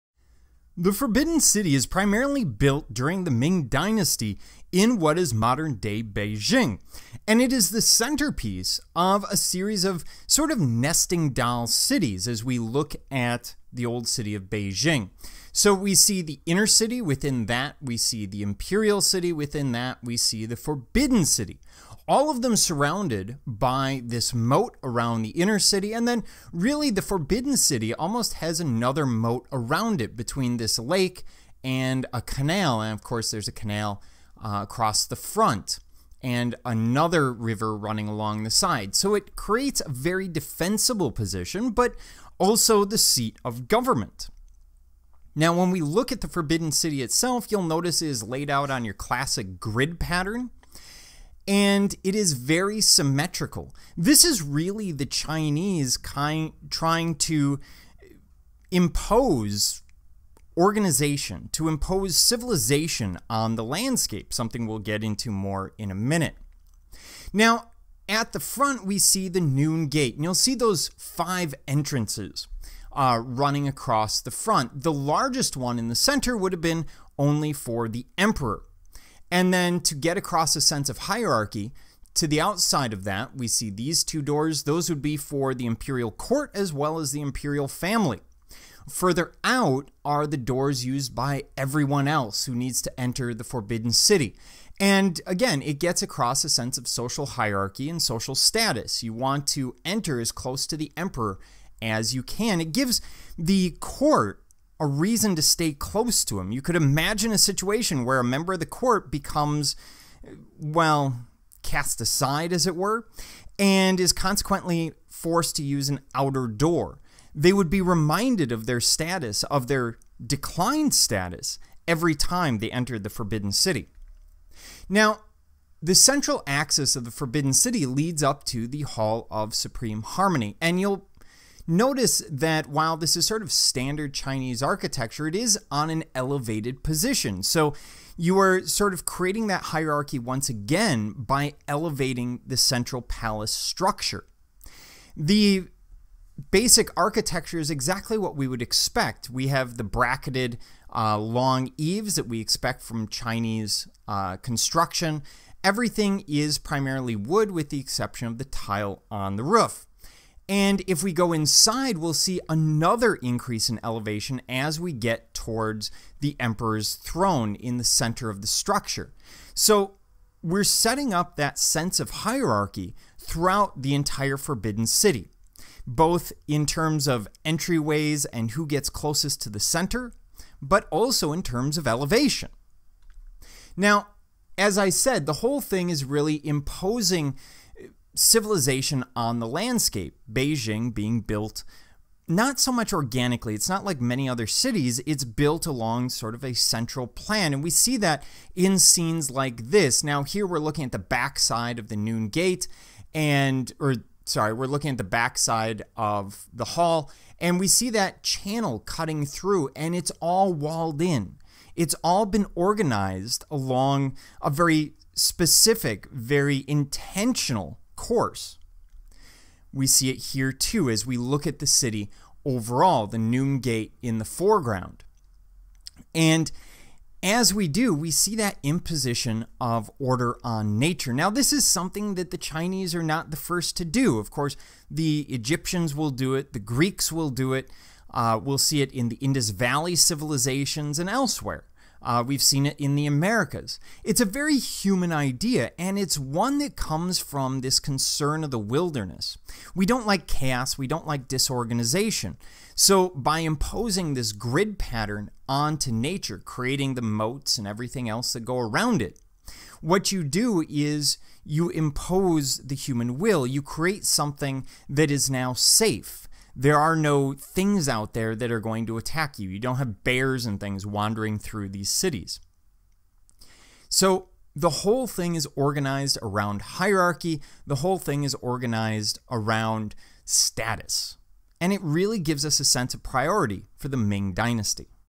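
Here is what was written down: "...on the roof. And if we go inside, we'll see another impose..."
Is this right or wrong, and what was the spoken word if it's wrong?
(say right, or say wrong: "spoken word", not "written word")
wrong: "increase", not "impose".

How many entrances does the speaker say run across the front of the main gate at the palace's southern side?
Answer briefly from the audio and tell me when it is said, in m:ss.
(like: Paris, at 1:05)
5, at 1:10.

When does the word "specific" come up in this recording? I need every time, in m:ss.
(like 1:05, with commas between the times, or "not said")
3:35.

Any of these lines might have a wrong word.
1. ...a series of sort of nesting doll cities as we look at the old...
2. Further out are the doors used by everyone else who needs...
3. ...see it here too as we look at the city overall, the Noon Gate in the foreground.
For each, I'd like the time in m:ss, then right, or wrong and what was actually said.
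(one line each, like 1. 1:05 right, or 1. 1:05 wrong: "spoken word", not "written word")
1. 0:09 right
2. 1:28 right
3. 3:39 right.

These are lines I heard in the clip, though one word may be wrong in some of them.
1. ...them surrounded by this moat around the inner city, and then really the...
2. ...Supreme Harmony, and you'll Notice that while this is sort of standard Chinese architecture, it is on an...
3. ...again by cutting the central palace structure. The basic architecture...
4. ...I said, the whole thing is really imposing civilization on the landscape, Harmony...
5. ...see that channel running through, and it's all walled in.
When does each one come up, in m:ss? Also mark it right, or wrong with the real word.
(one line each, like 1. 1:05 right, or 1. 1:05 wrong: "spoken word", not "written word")
1. 0:22 right
2. 2:09 right
3. 2:20 wrong: "elevating", not "cutting"
4. 3:04 wrong: "Beijing", not "Harmony"
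5. 3:27 wrong: "cutting", not "running".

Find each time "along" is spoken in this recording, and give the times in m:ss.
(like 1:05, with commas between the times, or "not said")
0:38, 3:15, 3:33.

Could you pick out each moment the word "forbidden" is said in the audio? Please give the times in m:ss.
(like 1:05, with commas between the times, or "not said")
0:00, 0:20, 0:27, 0:46, 1:33, 2:03, 2:07, 2:54.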